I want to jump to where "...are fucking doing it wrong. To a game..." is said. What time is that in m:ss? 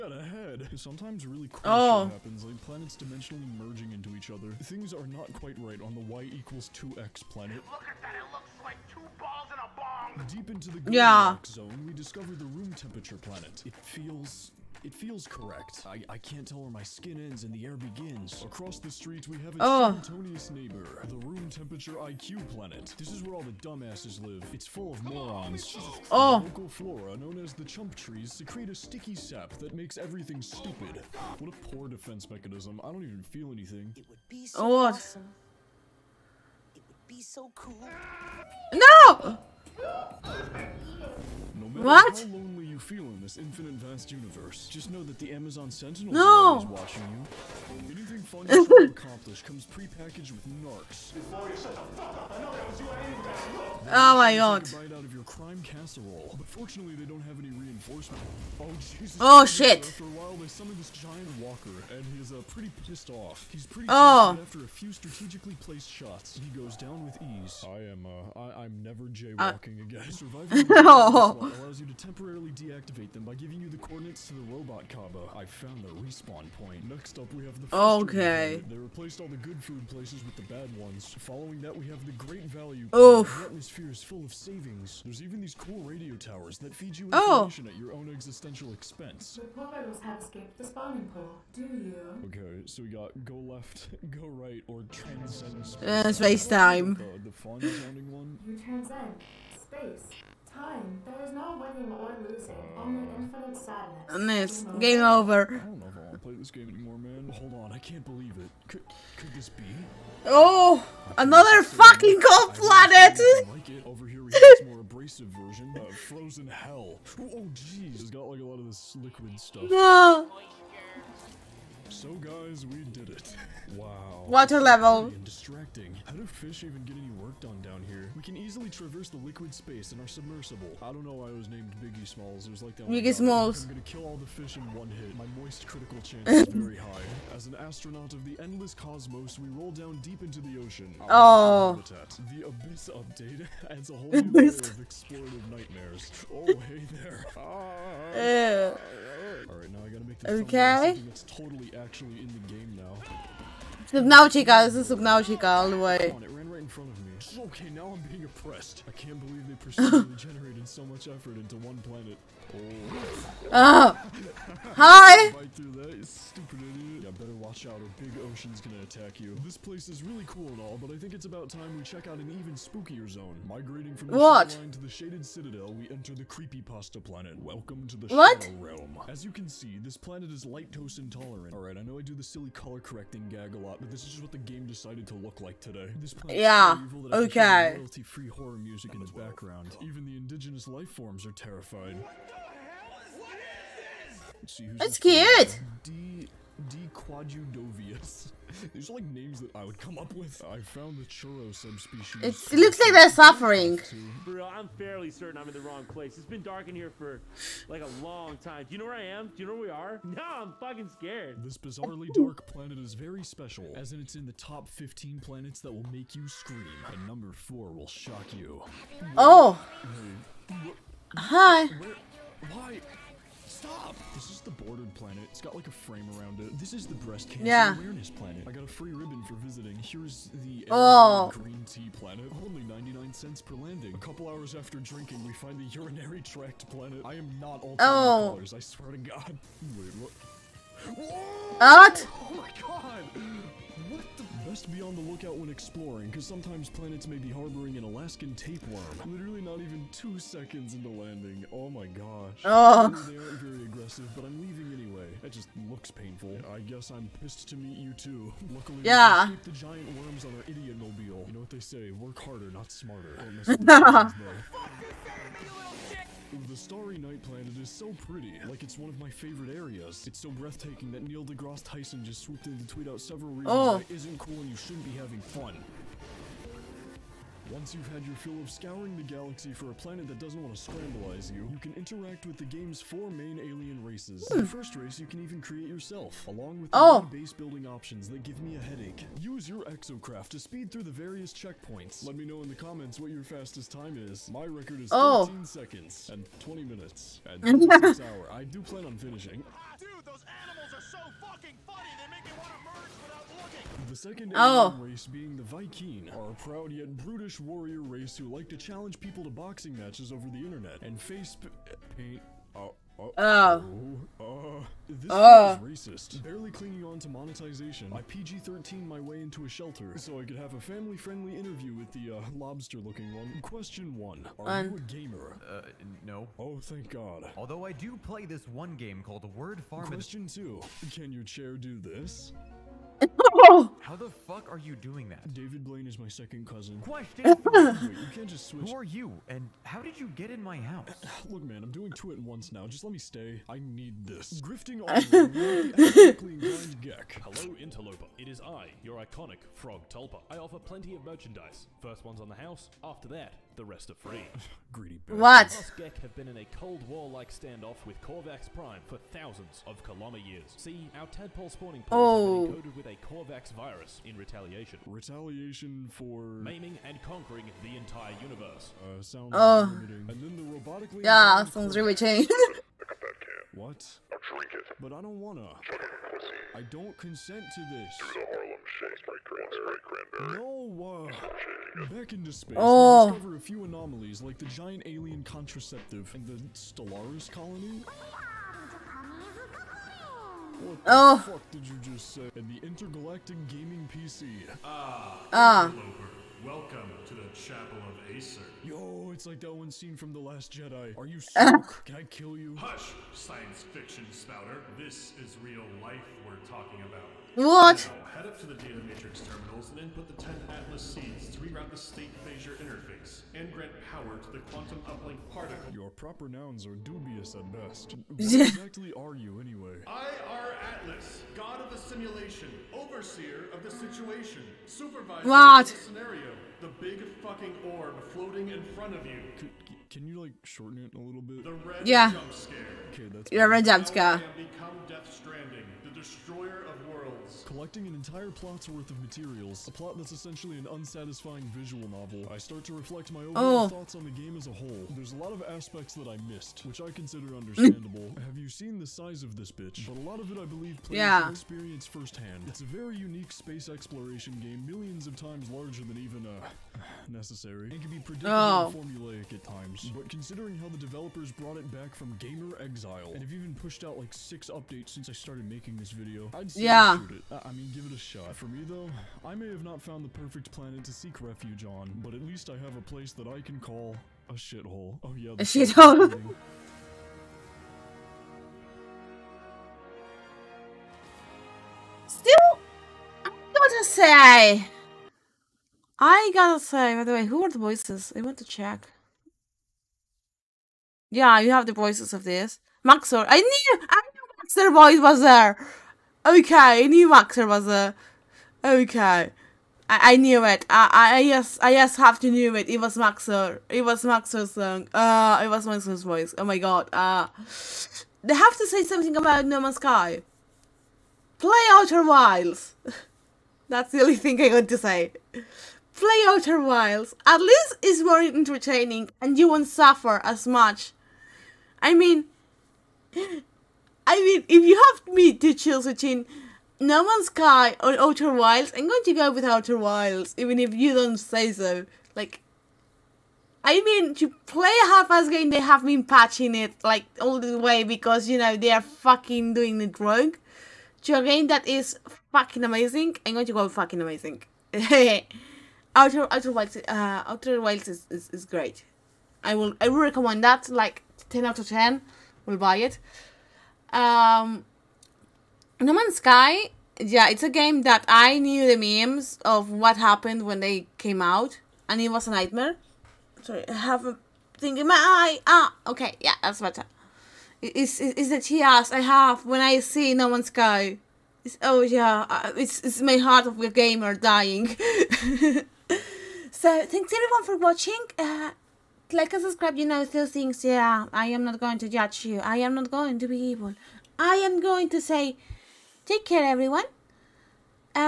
8:58.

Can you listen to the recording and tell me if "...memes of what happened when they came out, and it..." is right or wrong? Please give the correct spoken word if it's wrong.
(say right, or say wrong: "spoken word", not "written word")
right.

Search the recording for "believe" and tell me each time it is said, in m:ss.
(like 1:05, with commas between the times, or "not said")
1:48, 2:39, 7:30.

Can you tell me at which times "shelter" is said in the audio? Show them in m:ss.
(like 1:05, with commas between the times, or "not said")
5:19.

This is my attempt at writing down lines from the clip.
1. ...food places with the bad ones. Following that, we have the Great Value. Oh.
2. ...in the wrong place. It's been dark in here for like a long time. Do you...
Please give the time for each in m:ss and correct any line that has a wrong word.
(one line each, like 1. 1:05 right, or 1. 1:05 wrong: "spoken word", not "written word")
1. 1:19 right
2. 3:25 right.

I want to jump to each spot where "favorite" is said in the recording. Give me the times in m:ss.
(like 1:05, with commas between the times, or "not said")
4:29.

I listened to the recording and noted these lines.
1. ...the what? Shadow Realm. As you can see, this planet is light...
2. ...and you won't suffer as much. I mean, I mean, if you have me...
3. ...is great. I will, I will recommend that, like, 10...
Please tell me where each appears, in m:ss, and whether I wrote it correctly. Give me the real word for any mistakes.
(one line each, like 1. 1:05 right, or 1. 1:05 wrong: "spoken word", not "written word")
1. 2:57 right
2. 8:39 right
3. 9:08 right.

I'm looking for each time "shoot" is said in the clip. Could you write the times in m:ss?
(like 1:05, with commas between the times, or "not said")
7:46.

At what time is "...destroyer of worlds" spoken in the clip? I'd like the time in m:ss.
7:15.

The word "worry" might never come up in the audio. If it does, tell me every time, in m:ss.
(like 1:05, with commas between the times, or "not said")
not said.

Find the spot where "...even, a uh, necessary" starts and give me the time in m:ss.
7:35.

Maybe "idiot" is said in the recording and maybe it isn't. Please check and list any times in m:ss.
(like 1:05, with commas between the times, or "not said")
2:46, 4:20.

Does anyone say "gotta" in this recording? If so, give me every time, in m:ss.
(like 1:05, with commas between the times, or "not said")
2:29, 8:06.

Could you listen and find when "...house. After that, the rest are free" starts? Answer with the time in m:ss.
5:52.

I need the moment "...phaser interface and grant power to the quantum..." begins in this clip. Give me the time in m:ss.
6:52.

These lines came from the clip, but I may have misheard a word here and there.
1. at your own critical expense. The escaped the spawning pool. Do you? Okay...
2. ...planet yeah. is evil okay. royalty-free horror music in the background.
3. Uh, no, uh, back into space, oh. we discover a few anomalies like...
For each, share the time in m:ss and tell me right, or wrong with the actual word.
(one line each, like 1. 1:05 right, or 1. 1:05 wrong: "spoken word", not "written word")
1. 1:27 wrong: "existential", not "critical"
2. 3:06 right
3. 6:20 right.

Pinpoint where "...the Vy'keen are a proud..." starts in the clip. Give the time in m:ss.
5:05.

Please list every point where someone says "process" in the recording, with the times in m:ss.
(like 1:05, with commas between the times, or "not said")
not said.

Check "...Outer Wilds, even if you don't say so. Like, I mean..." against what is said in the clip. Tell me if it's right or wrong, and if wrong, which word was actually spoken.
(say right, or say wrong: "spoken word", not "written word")
right.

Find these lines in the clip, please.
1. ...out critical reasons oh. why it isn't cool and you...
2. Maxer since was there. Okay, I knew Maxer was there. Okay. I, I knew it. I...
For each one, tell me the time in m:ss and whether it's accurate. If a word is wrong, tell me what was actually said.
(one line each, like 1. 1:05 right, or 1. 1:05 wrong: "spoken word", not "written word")
1. 4:32 wrong: "several", not "critical"
2. 8:14 wrong: "voice", not "since".